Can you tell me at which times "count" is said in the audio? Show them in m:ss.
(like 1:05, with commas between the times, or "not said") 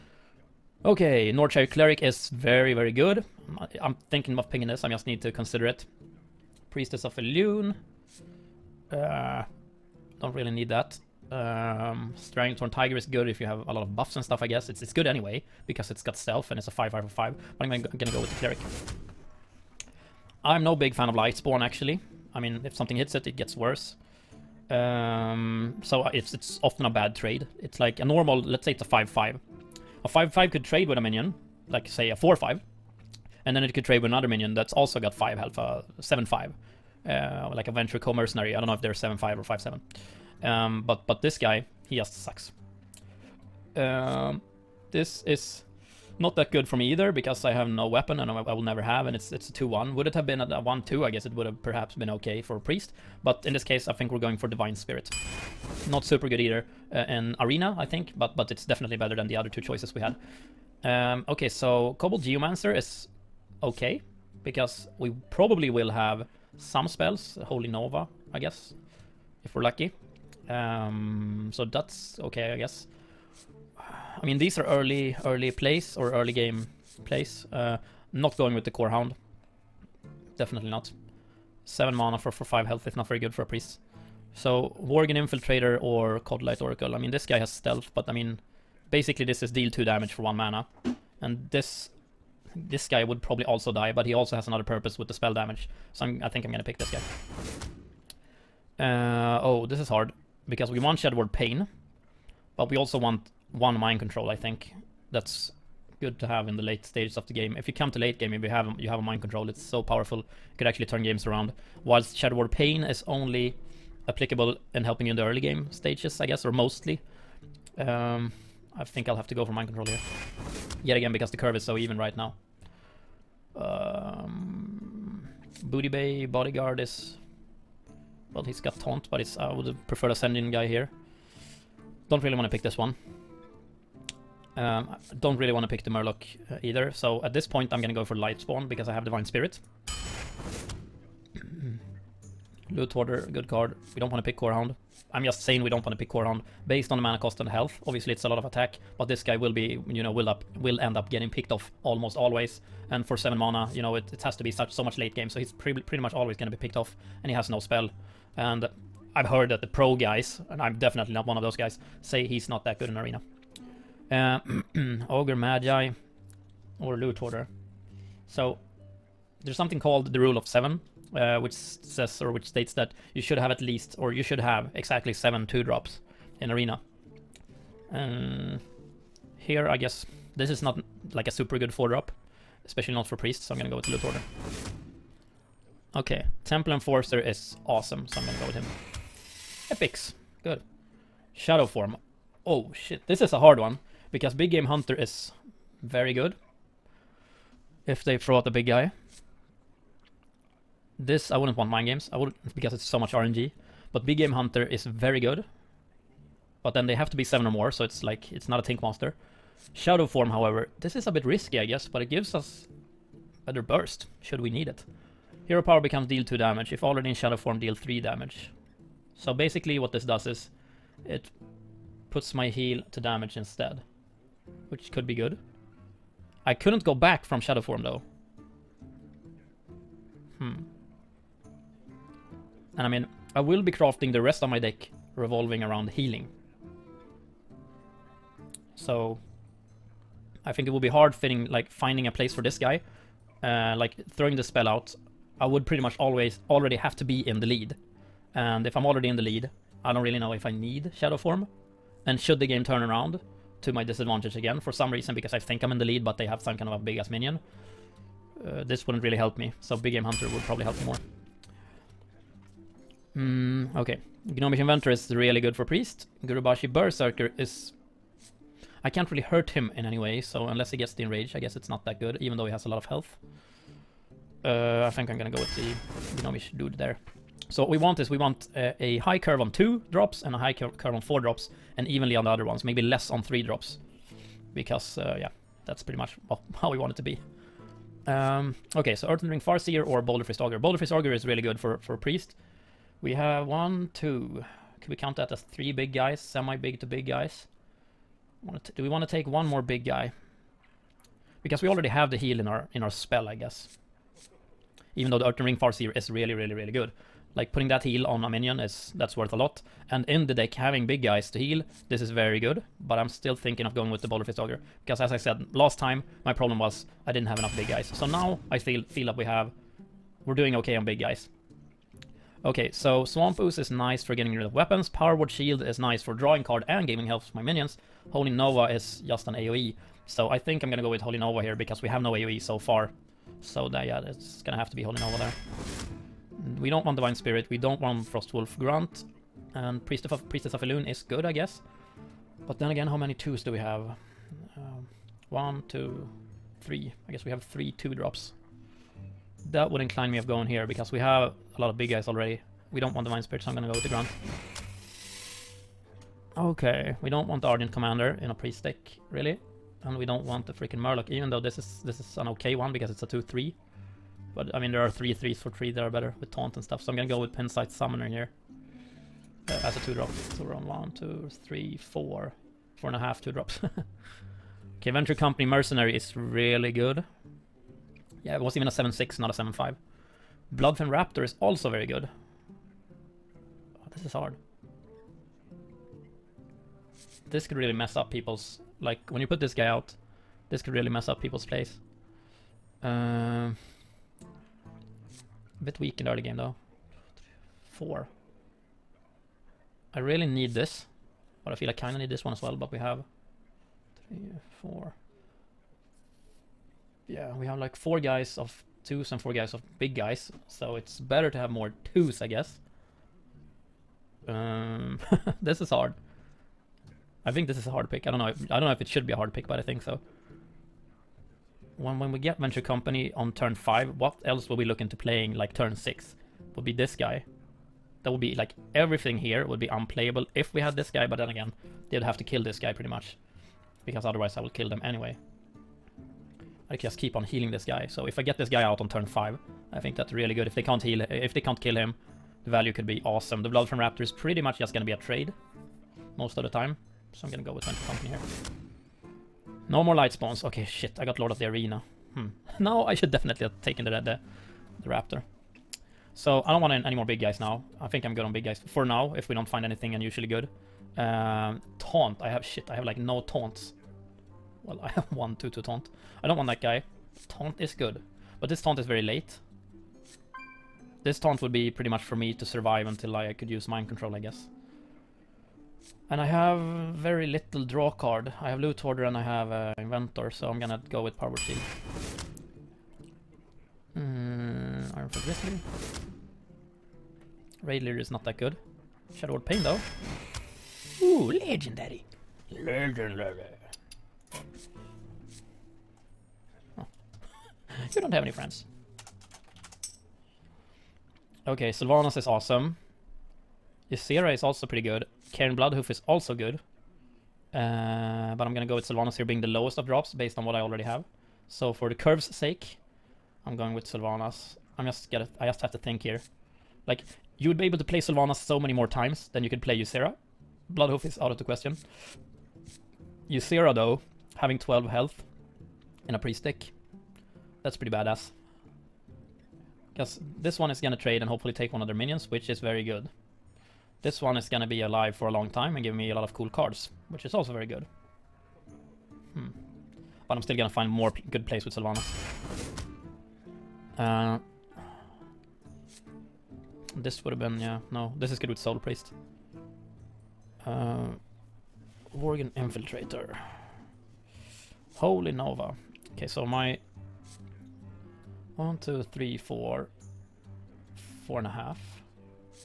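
4:54.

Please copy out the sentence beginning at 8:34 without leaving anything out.
I'm just going to I just have to think here.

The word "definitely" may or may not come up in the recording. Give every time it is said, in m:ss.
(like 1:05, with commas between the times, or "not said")
0:58, 1:20, 2:40, 7:33.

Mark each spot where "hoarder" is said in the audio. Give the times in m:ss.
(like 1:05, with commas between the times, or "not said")
2:22, 3:03, 7:58.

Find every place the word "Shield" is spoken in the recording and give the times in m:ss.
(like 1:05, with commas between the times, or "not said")
5:25, 8:01.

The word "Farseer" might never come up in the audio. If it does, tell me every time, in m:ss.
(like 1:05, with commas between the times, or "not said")
4:49, 5:05.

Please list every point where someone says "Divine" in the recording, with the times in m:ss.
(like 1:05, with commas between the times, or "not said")
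0:54, 2:19, 5:36.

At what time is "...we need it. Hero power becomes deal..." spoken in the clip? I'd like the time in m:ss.
3:34.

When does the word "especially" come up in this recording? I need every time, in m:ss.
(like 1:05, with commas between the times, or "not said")
3:02.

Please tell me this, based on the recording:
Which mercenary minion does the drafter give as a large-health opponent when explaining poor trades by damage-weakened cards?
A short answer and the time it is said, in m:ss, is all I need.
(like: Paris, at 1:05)
Venture Co Mercenary, at 0:37.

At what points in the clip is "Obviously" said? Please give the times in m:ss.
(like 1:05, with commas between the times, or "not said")
2:27.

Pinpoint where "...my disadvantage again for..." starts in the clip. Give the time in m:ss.
4:13.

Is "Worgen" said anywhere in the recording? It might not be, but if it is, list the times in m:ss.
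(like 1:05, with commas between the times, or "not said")
1:24, 9:12.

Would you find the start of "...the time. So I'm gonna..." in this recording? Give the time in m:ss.
7:26.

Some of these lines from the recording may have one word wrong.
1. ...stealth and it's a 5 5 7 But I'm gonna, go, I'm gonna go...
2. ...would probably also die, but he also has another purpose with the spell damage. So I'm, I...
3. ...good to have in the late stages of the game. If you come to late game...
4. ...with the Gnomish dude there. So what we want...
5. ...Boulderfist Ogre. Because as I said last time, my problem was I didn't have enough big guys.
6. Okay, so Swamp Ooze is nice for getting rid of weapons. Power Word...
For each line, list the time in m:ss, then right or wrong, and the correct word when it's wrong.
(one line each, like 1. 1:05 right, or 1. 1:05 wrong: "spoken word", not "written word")
1. 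0:16 wrong: "5", not "7"
2. 1:33 right
3. 1:45 right
4. 4:35 right
5. 5:14 right
6. 5:22 right.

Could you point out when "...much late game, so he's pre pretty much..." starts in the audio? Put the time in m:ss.
2:34.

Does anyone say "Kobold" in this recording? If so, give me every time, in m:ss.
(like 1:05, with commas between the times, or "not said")
1:01.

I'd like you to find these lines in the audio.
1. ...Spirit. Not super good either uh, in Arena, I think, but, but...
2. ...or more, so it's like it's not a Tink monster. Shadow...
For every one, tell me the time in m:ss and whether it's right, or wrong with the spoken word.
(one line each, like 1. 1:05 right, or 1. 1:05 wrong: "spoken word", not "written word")
1. 0:54 right
2. 3:27 right.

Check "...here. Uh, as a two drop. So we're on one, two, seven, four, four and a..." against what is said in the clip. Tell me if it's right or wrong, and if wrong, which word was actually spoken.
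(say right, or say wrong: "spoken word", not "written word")
wrong: "three", not "seven".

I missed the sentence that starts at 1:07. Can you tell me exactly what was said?
Holy Nova, I guess, if we're lucky.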